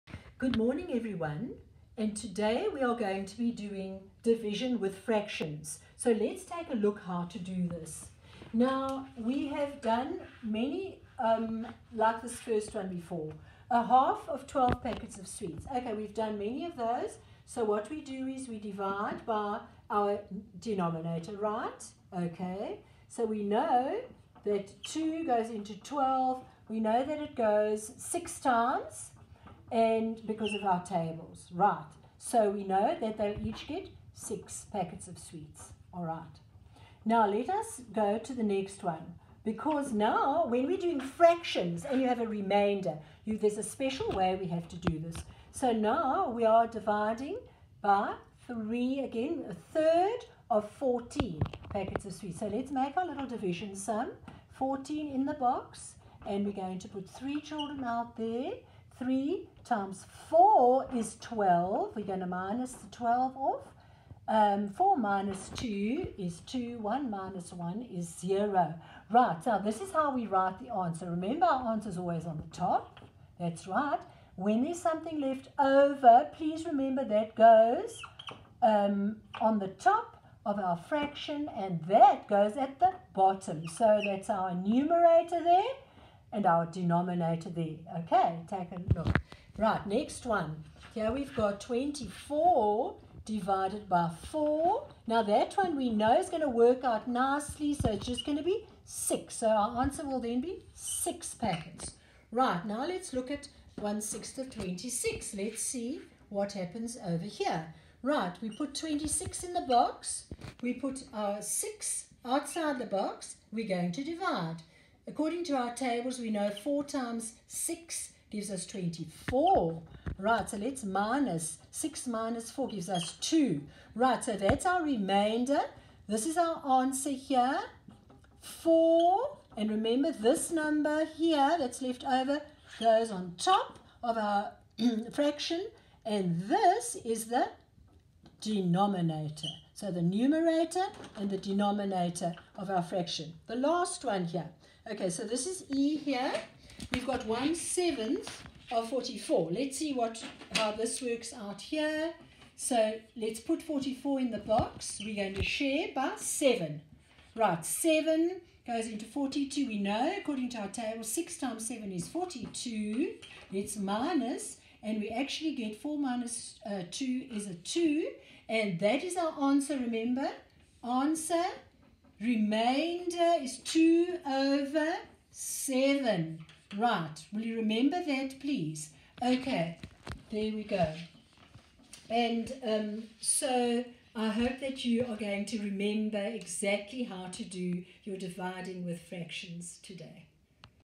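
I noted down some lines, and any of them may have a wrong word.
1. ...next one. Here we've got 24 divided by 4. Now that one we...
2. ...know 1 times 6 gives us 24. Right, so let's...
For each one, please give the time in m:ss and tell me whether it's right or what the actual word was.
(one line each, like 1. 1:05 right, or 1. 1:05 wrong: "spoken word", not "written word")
1. 1:29 right
2. 1:56 wrong: "4", not "1".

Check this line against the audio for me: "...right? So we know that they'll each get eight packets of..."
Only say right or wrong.
wrong.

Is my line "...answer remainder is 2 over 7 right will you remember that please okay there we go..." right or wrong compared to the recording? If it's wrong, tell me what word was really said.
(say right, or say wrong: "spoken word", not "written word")
right.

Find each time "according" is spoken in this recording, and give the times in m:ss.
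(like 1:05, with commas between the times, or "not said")
1:55, 2:40.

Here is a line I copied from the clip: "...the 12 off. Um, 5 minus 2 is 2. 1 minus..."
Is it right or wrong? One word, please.
wrong.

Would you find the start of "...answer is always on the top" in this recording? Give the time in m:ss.
1:11.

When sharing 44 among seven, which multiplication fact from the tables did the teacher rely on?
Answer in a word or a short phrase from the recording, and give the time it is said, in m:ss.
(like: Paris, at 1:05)
6 times 7 is 42, at 2:41.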